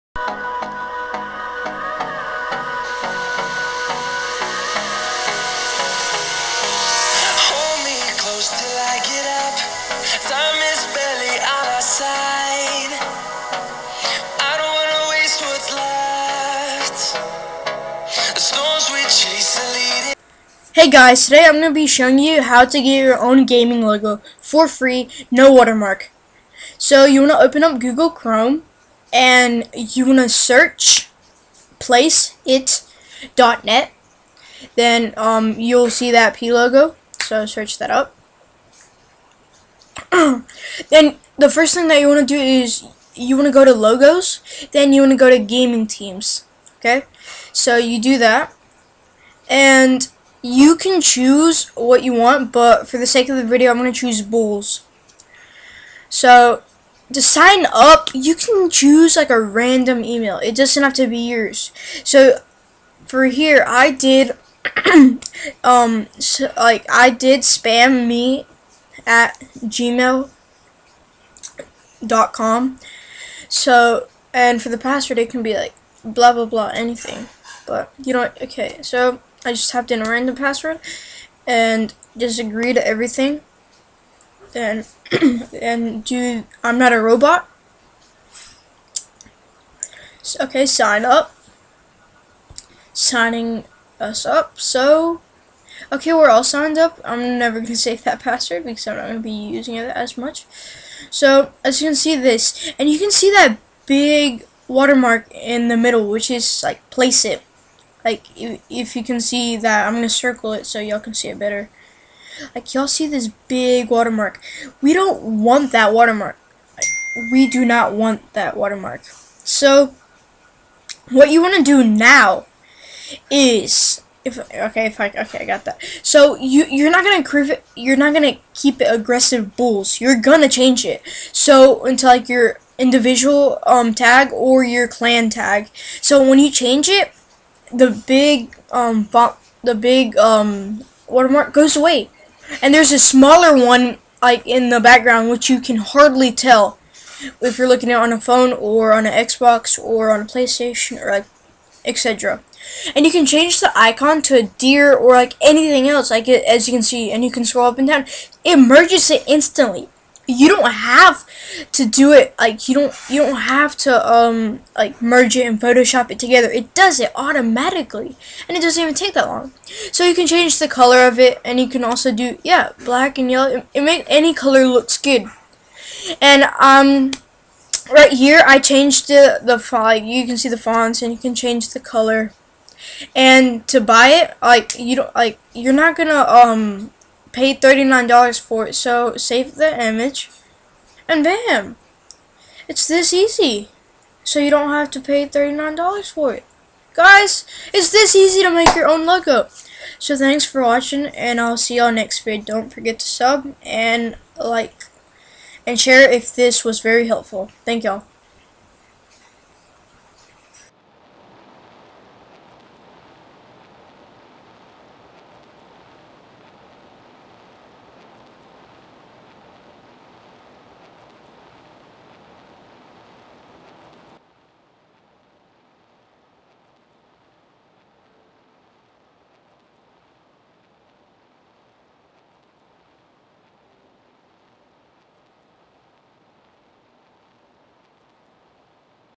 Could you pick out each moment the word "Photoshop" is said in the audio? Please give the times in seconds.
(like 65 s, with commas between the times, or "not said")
165 s.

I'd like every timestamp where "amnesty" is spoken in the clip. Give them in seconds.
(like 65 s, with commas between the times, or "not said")
not said.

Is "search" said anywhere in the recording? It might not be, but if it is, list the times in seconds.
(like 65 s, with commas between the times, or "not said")
30 s, 37 s.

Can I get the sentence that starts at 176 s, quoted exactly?
And um right here I changed the the font.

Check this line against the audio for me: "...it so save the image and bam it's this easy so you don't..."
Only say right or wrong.
right.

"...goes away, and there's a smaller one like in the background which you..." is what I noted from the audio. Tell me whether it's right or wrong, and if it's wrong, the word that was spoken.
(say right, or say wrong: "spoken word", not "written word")
right.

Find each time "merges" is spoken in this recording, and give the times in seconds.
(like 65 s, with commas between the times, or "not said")
158 s, 165 s.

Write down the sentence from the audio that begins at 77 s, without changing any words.
But you don't, okay, so I just typed in a random password and just agree to everything.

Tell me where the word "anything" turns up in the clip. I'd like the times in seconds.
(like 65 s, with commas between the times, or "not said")
76 s, 155 s.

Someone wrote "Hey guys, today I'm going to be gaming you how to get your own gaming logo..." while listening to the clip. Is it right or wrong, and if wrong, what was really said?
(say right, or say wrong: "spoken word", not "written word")
wrong: "showing", not "gaming".